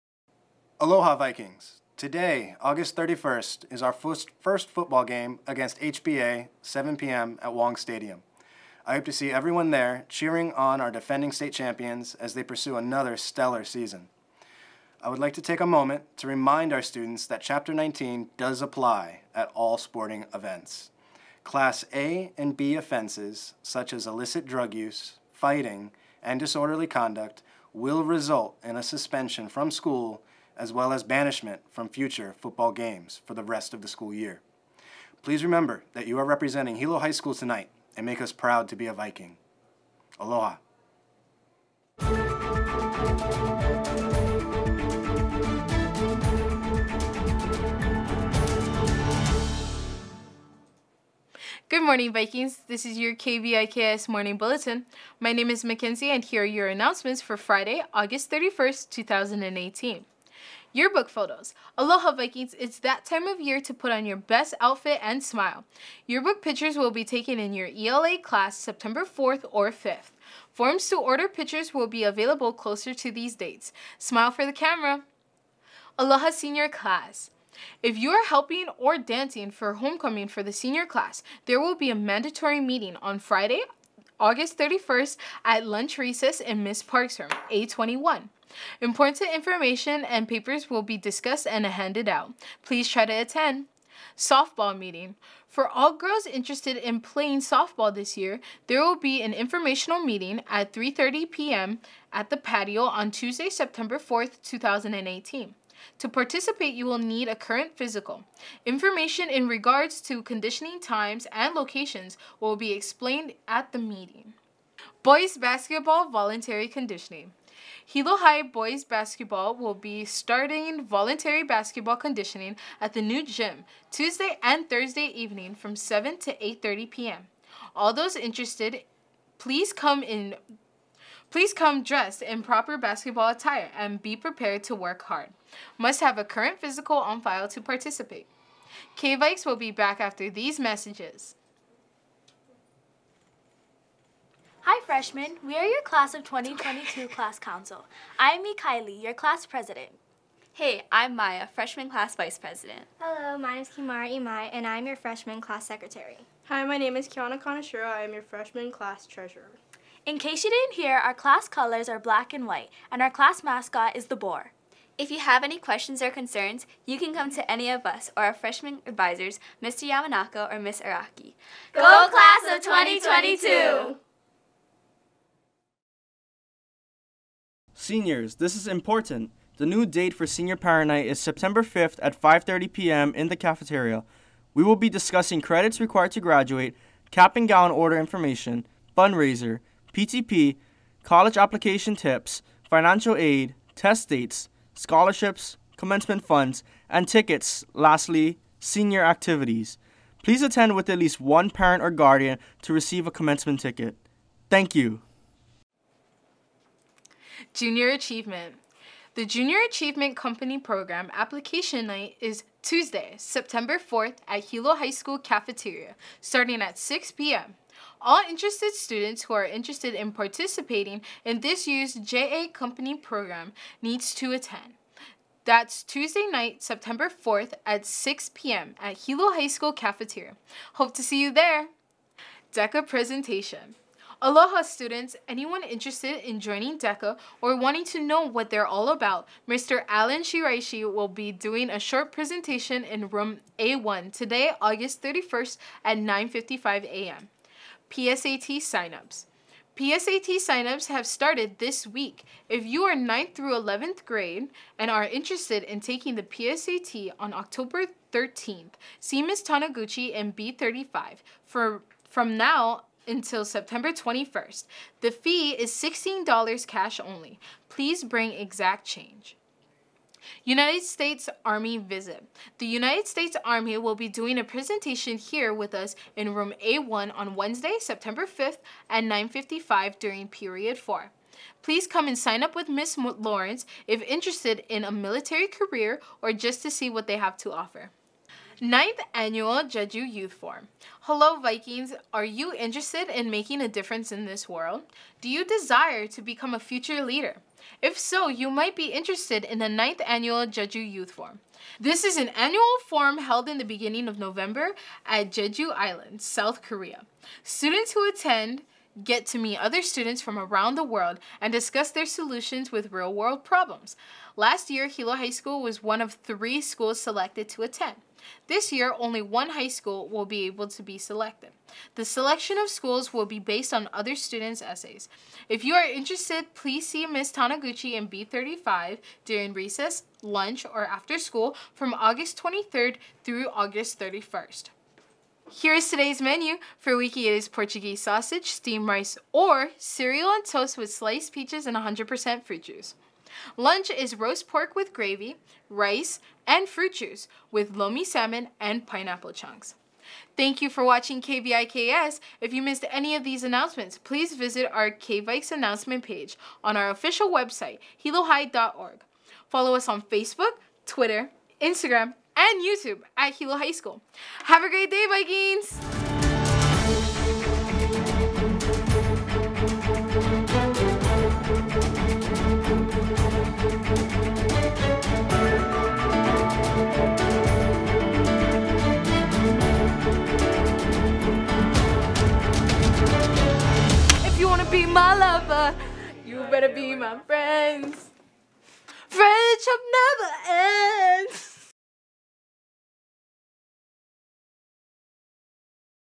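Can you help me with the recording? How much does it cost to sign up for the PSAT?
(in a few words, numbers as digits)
$16.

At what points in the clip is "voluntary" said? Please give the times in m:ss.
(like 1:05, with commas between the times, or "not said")
1:56, 2:00.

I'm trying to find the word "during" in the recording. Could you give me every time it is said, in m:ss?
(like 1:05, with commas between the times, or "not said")
4:39, 5:29.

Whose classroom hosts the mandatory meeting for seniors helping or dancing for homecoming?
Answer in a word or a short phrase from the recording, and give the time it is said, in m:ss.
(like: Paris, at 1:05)
Miss Park, at 1:26.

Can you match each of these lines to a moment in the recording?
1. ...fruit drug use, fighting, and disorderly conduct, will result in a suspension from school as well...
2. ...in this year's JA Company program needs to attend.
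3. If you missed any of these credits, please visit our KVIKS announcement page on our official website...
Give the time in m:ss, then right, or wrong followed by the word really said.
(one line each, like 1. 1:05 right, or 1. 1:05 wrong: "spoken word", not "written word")
1. 0:24 wrong: "illicit", not "fruit"
2. 3:41 right
3. 5:52 wrong: "announcements", not "credits".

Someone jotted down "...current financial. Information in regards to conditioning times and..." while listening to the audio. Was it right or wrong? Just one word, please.
wrong.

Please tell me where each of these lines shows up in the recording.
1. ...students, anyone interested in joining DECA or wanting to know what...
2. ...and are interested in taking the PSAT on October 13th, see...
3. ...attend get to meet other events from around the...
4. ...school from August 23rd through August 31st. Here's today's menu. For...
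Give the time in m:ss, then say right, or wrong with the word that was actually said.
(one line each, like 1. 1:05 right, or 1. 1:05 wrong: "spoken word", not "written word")
1. 3:54 right
2. 4:14 right
3. 5:08 wrong: "students", not "events"
4. 5:31 right.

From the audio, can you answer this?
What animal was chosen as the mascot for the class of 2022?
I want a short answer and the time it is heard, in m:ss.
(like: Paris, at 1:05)
boar, at 2:44.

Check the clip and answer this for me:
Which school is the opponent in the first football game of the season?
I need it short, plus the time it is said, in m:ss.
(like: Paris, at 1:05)
HBA, at 0:05.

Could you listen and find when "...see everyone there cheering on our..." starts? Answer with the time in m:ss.
0:09.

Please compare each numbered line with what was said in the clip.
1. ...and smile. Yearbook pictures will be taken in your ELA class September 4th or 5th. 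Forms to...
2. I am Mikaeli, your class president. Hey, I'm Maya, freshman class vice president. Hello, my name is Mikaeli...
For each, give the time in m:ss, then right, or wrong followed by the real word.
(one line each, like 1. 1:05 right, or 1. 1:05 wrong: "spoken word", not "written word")
1. 1:05 right
2. 2:28 wrong: "Kimara", not "Mikaeli".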